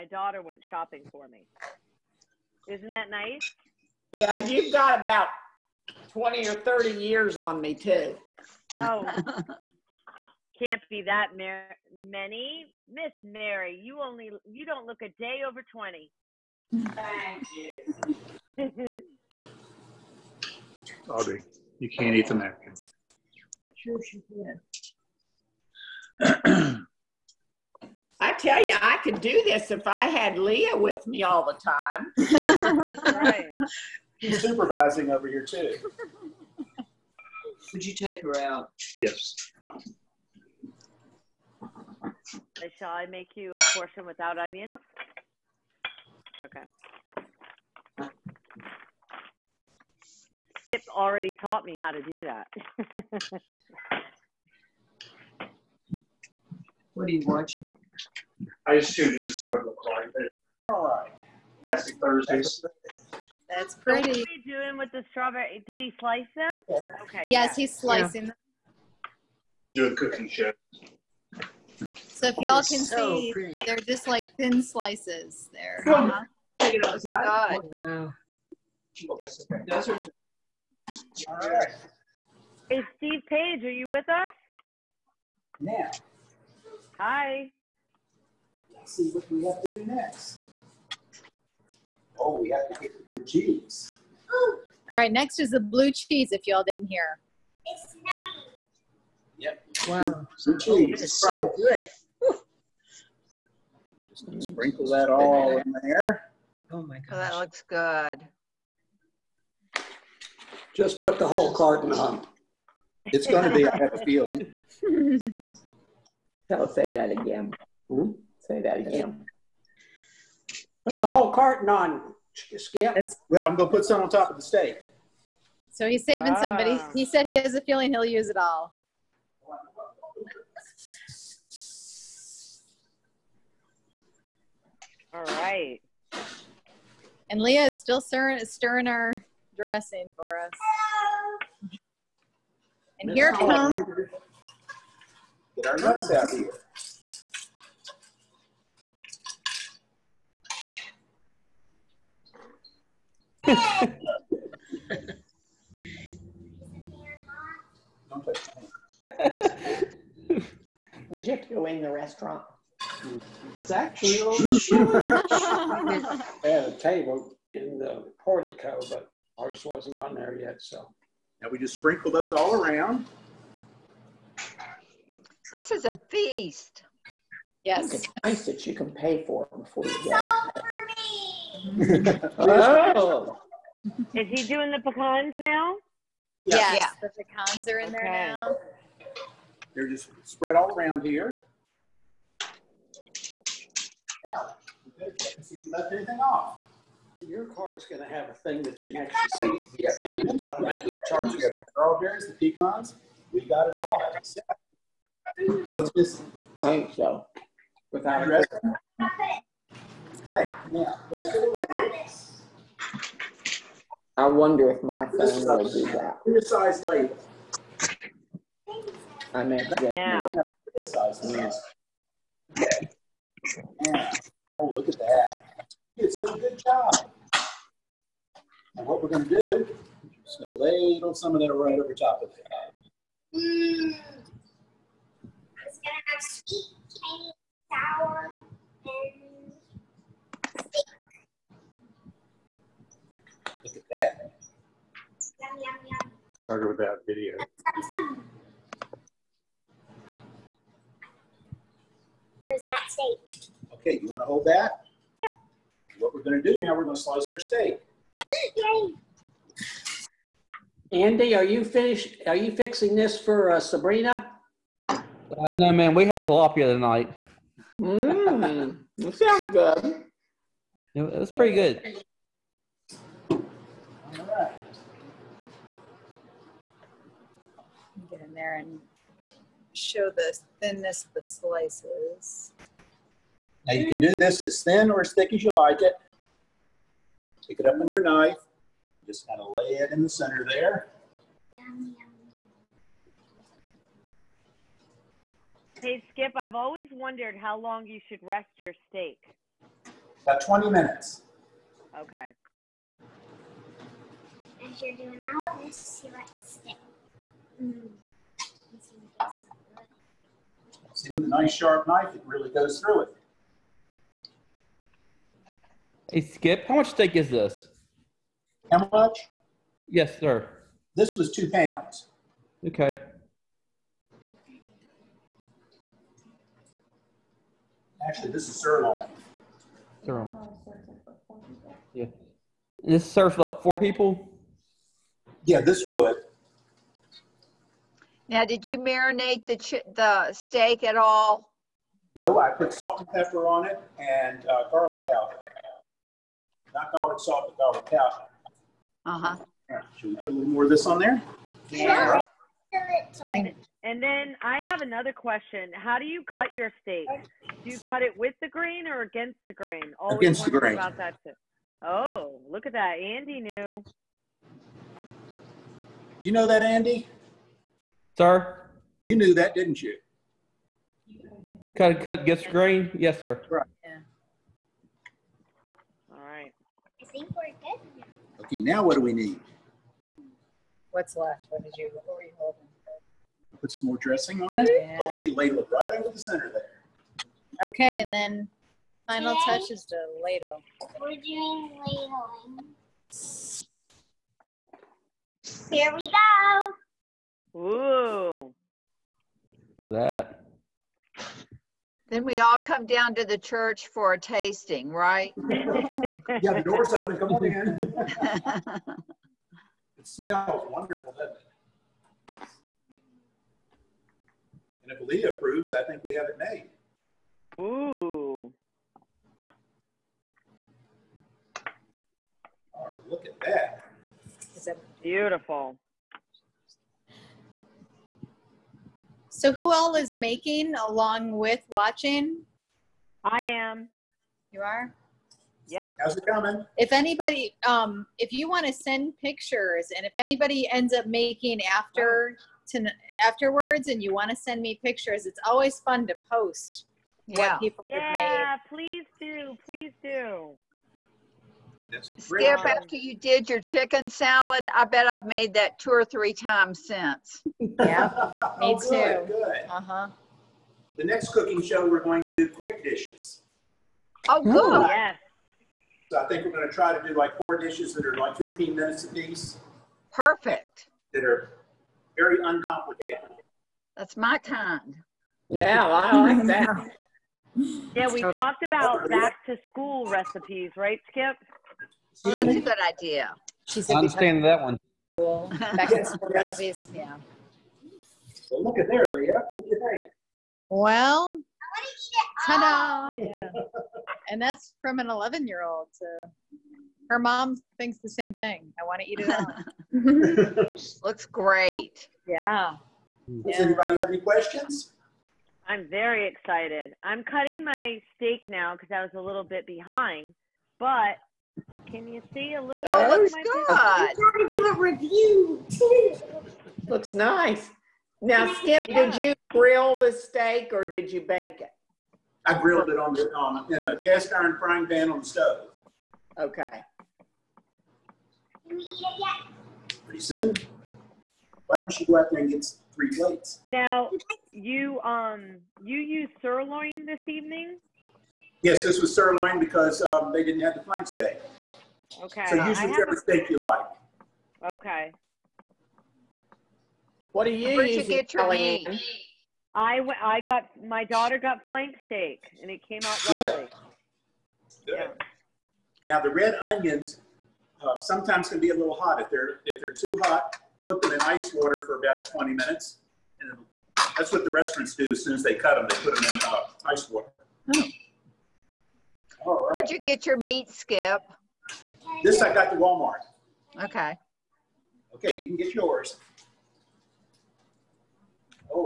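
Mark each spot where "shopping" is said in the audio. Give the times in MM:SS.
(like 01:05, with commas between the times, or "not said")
00:00.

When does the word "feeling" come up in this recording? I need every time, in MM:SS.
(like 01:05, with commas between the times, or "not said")
01:54, 02:07.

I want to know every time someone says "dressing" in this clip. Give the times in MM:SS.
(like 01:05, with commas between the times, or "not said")
02:19, 06:23.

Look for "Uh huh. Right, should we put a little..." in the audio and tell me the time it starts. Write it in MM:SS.
05:49.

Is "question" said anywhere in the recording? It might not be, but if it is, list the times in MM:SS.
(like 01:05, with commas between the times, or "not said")
05:55, 08:24.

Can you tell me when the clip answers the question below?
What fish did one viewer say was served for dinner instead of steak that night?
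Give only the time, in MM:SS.
04:26.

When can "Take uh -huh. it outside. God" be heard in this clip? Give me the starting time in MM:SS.
01:16.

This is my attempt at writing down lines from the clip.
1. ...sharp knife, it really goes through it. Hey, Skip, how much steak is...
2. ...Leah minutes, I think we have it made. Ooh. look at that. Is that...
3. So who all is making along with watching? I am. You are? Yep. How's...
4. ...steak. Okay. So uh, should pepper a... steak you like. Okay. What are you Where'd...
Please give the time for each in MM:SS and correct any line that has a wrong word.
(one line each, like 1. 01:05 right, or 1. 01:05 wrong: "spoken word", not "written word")
1. 05:11 right
2. 06:55 wrong: "approves", not "minutes"
3. 07:09 right
4. 09:01 wrong: "whichever", not "pepper".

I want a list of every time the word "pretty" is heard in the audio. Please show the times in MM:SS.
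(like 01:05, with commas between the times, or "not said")
01:03, 01:13, 04:31, 08:50.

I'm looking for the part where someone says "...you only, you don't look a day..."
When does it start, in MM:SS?
00:13.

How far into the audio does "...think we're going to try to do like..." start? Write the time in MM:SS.
07:46.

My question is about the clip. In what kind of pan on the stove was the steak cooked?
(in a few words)
cast iron frying pan.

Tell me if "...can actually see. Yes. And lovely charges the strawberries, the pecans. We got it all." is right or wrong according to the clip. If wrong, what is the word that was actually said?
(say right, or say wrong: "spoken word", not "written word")
wrong: "automatically", not "lovely".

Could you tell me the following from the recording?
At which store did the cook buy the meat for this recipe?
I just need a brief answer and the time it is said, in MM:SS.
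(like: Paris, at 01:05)
Walmart, at 09:32.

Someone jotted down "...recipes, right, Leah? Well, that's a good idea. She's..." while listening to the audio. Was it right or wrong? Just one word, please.
wrong.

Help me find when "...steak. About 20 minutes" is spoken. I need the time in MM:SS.
04:58.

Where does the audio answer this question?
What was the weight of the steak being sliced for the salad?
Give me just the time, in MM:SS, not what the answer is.
05:21.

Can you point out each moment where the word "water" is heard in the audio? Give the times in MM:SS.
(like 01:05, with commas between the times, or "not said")
09:21, 09:27.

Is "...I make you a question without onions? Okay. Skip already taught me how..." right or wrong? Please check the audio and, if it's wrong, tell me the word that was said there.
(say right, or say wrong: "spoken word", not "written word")
wrong: "portion", not "question".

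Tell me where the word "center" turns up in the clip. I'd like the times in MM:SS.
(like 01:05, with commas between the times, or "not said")
04:50, 06:26.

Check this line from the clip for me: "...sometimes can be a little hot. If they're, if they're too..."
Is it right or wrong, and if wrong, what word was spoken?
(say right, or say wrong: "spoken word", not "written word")
right.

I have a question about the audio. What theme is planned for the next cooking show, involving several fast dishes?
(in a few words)
quick dishes.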